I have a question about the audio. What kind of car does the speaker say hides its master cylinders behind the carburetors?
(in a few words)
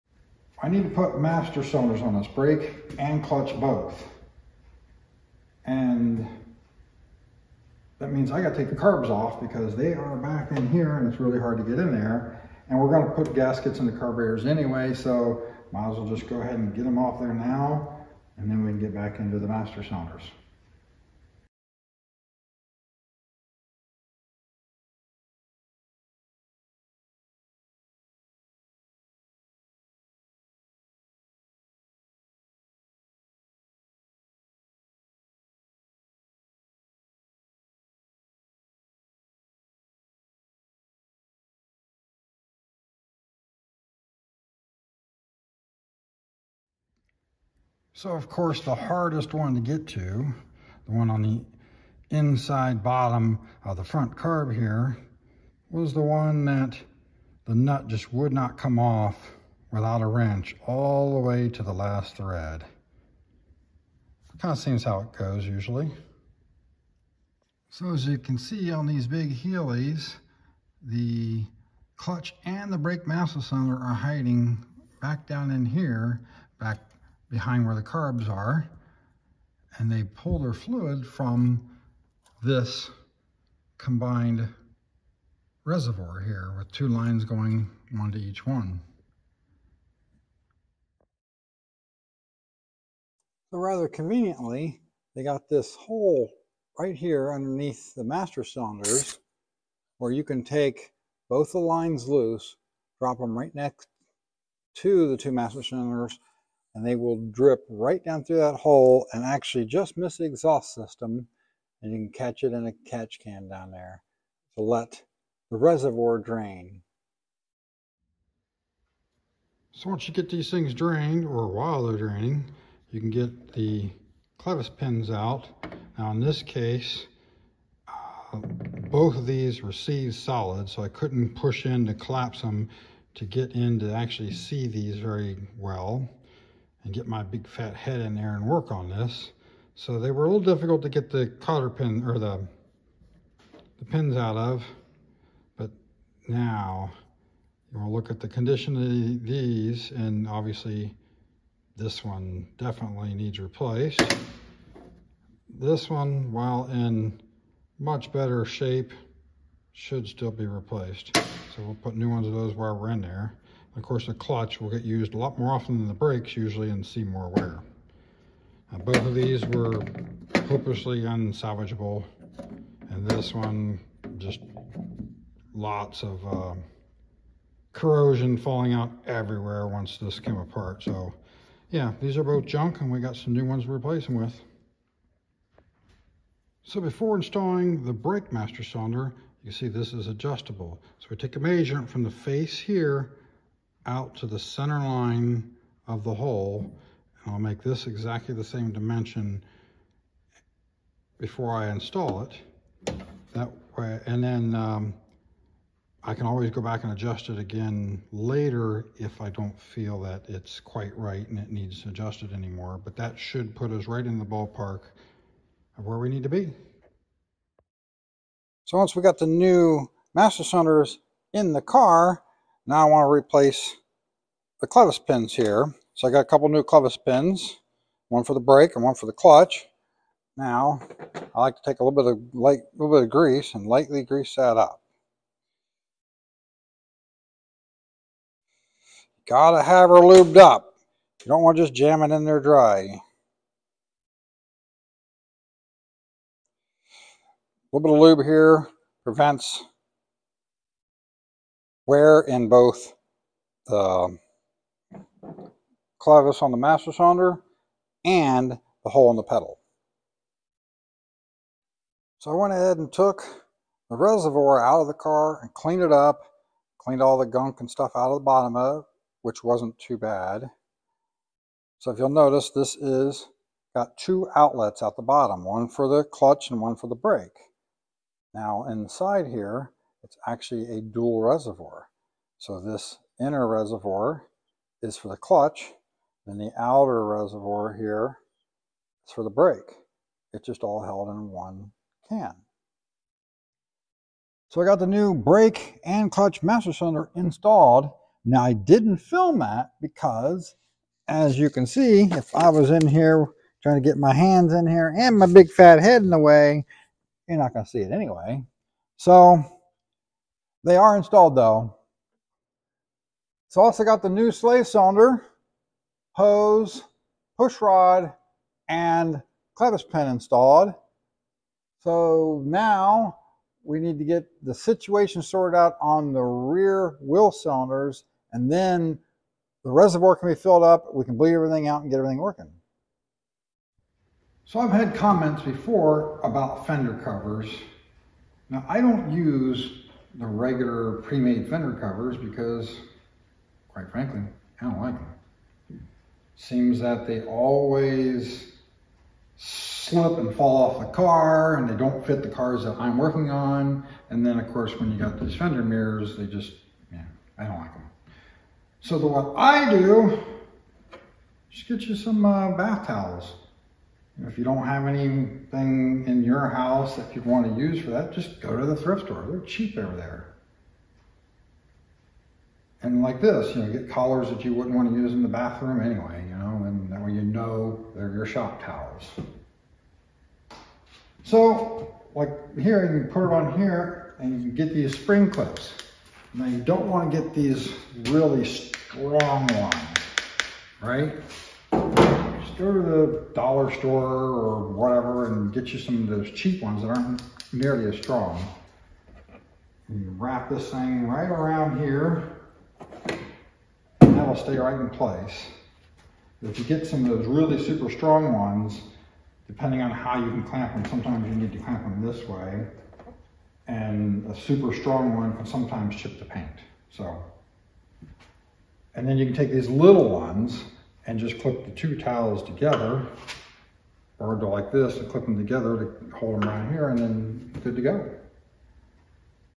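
Big Healeys.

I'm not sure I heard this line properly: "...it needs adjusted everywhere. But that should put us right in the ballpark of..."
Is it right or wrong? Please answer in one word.
wrong.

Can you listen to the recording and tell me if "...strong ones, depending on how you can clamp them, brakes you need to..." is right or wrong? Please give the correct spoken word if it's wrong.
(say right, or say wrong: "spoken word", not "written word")
wrong: "sometimes", not "brakes".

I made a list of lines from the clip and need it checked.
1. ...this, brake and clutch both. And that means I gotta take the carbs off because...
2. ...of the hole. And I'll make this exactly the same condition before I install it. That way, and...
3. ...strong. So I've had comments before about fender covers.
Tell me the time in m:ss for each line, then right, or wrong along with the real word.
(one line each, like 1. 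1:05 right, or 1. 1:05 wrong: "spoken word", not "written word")
1. 0:02 right
2. 3:15 wrong: "dimension", not "condition"
3. 5:32 wrong: "working", not "strong".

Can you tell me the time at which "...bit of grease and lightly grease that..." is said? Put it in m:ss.
3:52.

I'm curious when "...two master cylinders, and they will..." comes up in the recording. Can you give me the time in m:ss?
1:45.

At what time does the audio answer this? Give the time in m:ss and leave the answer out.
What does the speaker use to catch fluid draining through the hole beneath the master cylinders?
1:52.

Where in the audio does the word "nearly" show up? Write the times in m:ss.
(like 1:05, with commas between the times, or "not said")
6:37.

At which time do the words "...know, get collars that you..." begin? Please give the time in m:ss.
6:13.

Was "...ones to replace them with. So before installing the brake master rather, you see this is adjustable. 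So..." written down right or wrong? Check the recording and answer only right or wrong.
wrong.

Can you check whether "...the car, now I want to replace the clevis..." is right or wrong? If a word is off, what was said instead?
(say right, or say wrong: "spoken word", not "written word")
right.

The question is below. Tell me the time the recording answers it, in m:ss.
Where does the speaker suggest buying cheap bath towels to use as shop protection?
6:08.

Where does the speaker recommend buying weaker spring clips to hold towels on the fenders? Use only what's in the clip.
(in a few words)
Dollar store.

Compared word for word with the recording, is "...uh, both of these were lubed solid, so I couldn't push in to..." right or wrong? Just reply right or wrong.
wrong.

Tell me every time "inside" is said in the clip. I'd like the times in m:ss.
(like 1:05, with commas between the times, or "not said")
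0:52, 4:38.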